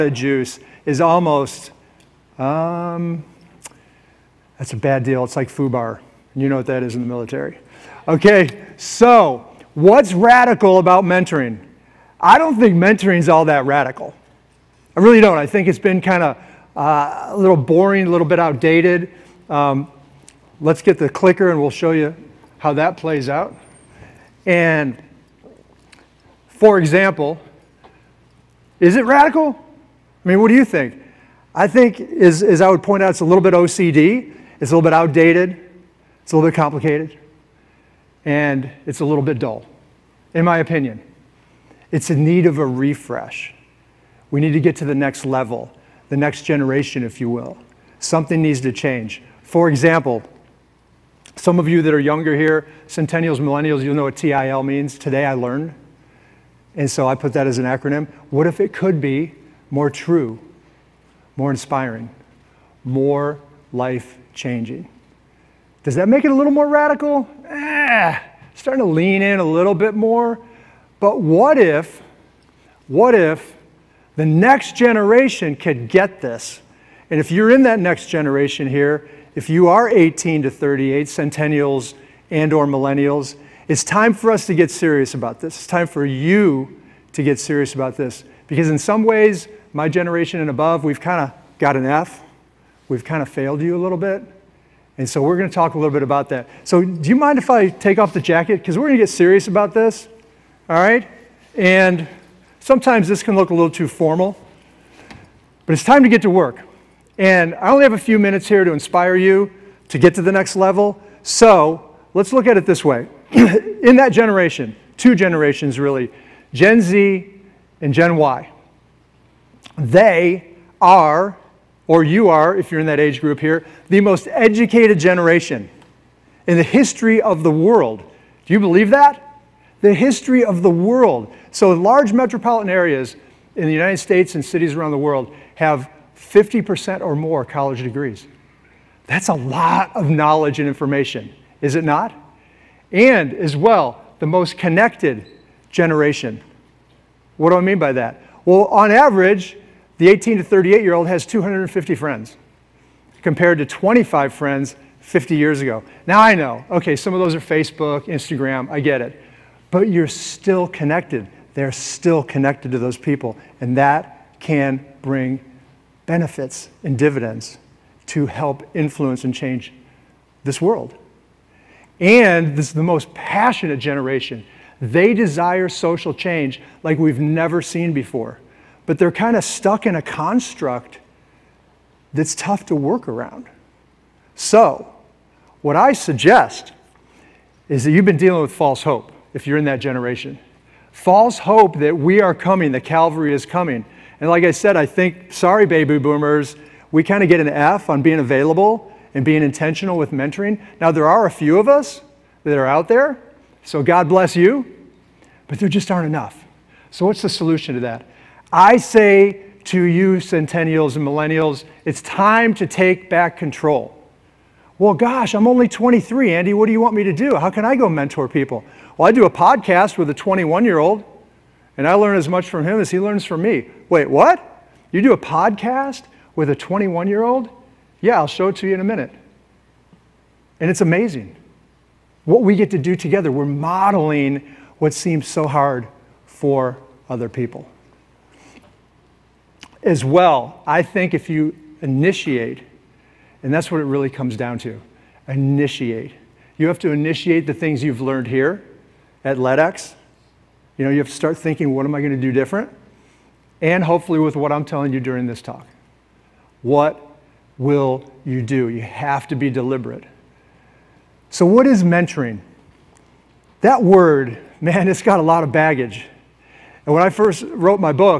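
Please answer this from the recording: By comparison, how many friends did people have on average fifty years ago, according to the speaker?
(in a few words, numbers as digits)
25.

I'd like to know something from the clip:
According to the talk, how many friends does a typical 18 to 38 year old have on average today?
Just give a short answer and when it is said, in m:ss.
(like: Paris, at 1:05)
250, at 2:31.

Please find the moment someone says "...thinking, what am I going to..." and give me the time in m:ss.
4:11.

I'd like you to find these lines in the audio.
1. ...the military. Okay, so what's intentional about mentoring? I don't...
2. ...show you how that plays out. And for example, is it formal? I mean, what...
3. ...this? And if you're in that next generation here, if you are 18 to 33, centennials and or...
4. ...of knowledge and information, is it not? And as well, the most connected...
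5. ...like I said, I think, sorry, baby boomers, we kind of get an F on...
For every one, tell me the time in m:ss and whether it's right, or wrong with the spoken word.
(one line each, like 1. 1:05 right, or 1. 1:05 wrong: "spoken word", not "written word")
1. 0:07 wrong: "radical", not "intentional"
2. 0:21 wrong: "radical", not "formal"
3. 1:16 wrong: "38", not "33"
4. 2:19 right
5. 3:14 right.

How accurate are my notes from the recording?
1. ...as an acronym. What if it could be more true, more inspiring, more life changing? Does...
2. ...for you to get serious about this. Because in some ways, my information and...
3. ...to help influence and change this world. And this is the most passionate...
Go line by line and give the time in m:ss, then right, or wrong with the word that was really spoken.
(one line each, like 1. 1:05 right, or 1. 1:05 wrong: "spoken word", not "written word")
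1. 0:57 right
2. 1:25 wrong: "generation", not "information"
3. 2:48 right.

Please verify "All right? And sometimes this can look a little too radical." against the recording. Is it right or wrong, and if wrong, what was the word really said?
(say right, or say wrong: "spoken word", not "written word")
wrong: "formal", not "radical".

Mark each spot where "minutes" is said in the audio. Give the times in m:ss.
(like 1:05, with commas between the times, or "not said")
1:48, 3:48.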